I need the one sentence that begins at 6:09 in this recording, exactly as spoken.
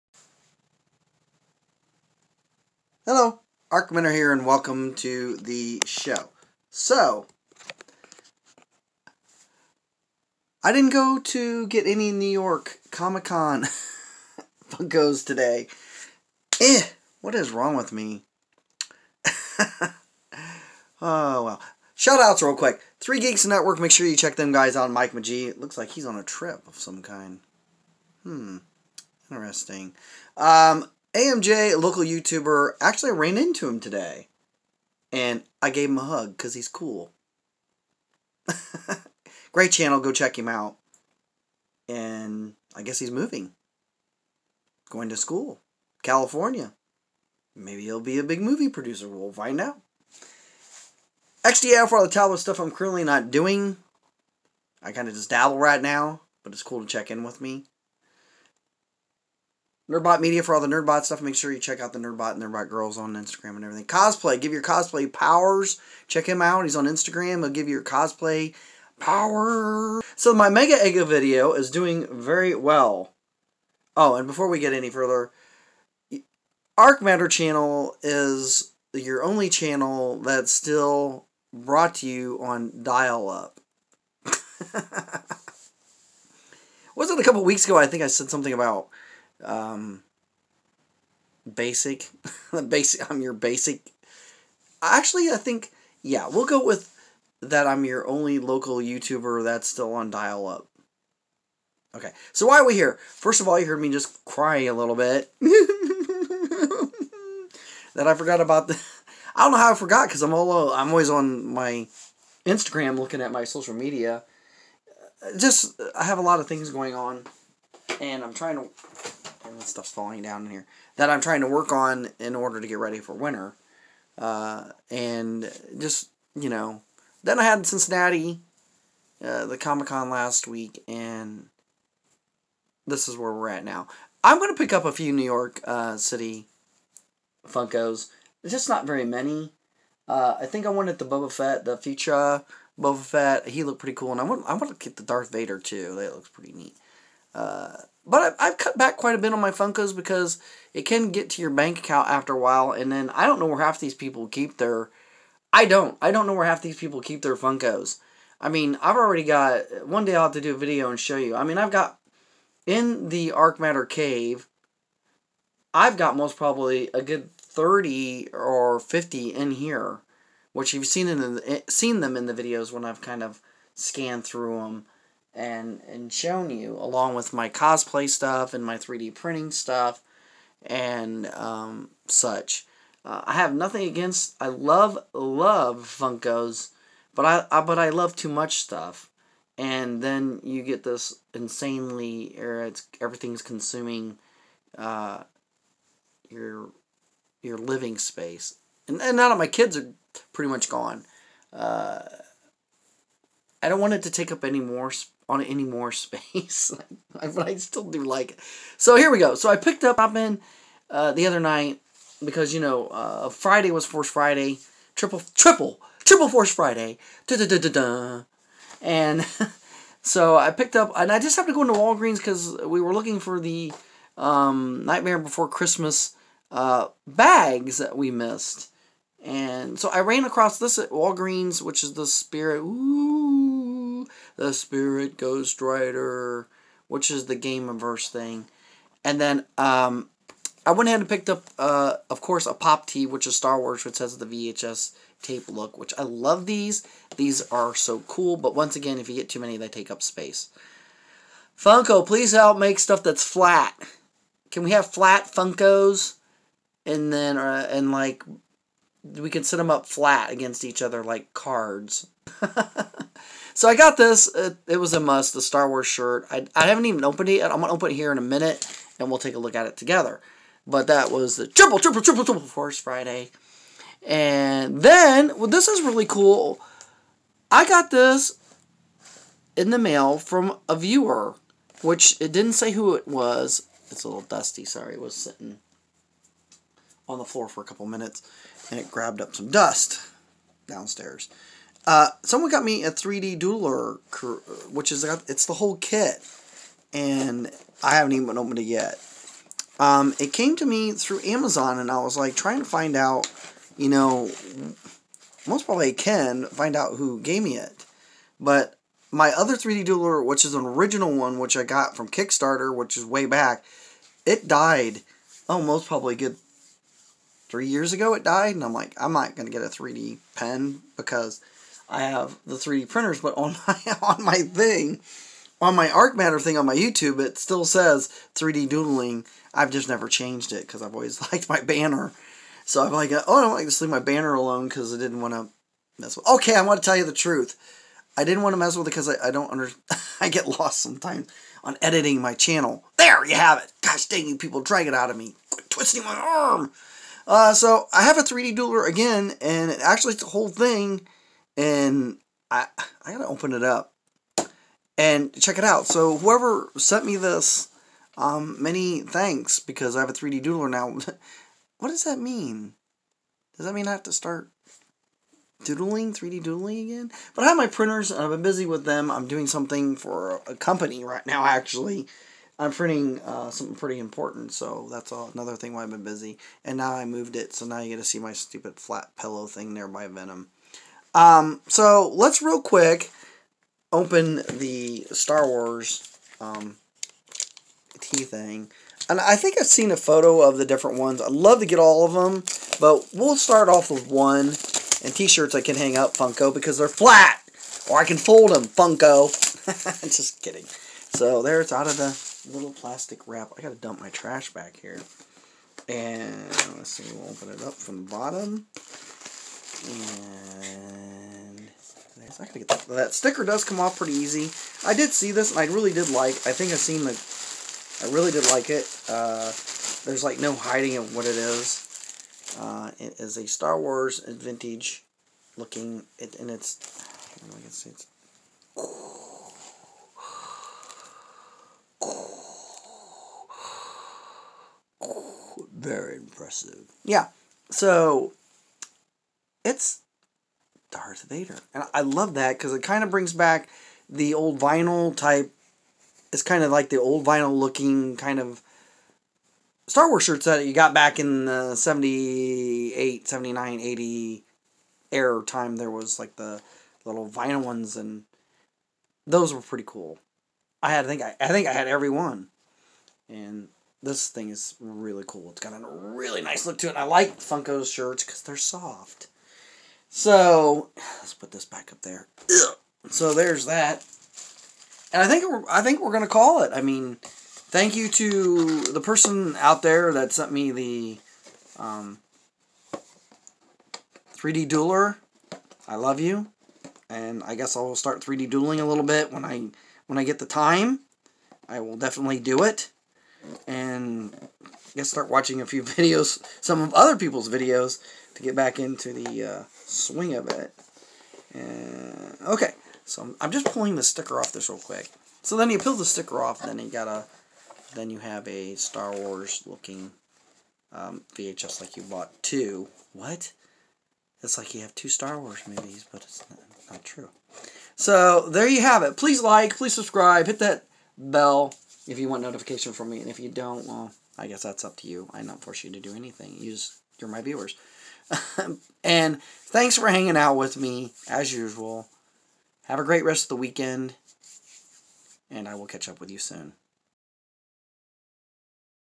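I'm doing something for a company right now, actually.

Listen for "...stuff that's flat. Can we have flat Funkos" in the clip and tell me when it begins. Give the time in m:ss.
4:12.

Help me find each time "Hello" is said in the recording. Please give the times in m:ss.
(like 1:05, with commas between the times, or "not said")
0:03.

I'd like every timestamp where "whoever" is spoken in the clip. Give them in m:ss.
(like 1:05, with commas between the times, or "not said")
5:56.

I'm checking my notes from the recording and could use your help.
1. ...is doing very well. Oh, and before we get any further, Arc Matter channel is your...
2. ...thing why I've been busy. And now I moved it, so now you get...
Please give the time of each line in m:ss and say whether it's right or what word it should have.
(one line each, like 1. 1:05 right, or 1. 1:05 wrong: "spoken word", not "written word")
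1. 1:11 right
2. 6:15 right.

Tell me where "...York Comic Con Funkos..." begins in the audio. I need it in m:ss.
0:12.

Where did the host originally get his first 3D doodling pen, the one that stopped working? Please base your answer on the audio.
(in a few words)
Kickstarter.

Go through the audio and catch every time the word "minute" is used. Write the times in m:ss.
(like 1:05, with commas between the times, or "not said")
4:28, 4:47.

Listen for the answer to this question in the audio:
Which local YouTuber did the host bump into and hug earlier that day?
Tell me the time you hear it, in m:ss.
0:31.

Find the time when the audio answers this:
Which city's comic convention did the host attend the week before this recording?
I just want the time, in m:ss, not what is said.
2:07.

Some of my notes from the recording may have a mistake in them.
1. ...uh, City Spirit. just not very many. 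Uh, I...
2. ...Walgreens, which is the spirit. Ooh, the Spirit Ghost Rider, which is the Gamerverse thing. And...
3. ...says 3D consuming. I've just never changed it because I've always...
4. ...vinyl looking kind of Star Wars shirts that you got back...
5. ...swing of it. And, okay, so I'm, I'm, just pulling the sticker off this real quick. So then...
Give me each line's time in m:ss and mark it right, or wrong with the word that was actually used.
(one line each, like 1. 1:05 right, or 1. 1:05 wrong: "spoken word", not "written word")
1. 2:15 wrong: "Funkos", not "Spirit"
2. 3:50 right
3. 5:27 wrong: "doodling", not "consuming"
4. 7:27 right
5. 8:19 right.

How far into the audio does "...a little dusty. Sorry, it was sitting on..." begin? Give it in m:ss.
4:44.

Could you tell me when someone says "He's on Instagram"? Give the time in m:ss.
1:06.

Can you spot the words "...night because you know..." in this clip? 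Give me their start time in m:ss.
3:31.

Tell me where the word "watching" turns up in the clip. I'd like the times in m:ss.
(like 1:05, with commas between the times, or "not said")
8:15.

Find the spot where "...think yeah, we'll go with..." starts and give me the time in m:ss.
1:35.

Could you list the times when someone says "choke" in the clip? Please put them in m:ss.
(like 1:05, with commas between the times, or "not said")
not said.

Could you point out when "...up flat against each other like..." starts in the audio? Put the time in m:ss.
4:19.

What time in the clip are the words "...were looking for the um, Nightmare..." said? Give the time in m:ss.
3:42.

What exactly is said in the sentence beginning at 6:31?
I'd love to get all of them, but we'll start off with one.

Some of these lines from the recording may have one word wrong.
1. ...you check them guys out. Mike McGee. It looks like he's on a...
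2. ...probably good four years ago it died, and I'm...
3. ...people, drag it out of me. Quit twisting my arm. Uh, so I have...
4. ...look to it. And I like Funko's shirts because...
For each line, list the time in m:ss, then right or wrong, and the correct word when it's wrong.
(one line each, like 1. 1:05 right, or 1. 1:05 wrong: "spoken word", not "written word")
1. 0:24 right
2. 5:15 wrong: "three", not "four"
3. 5:44 right
4. 7:46 right.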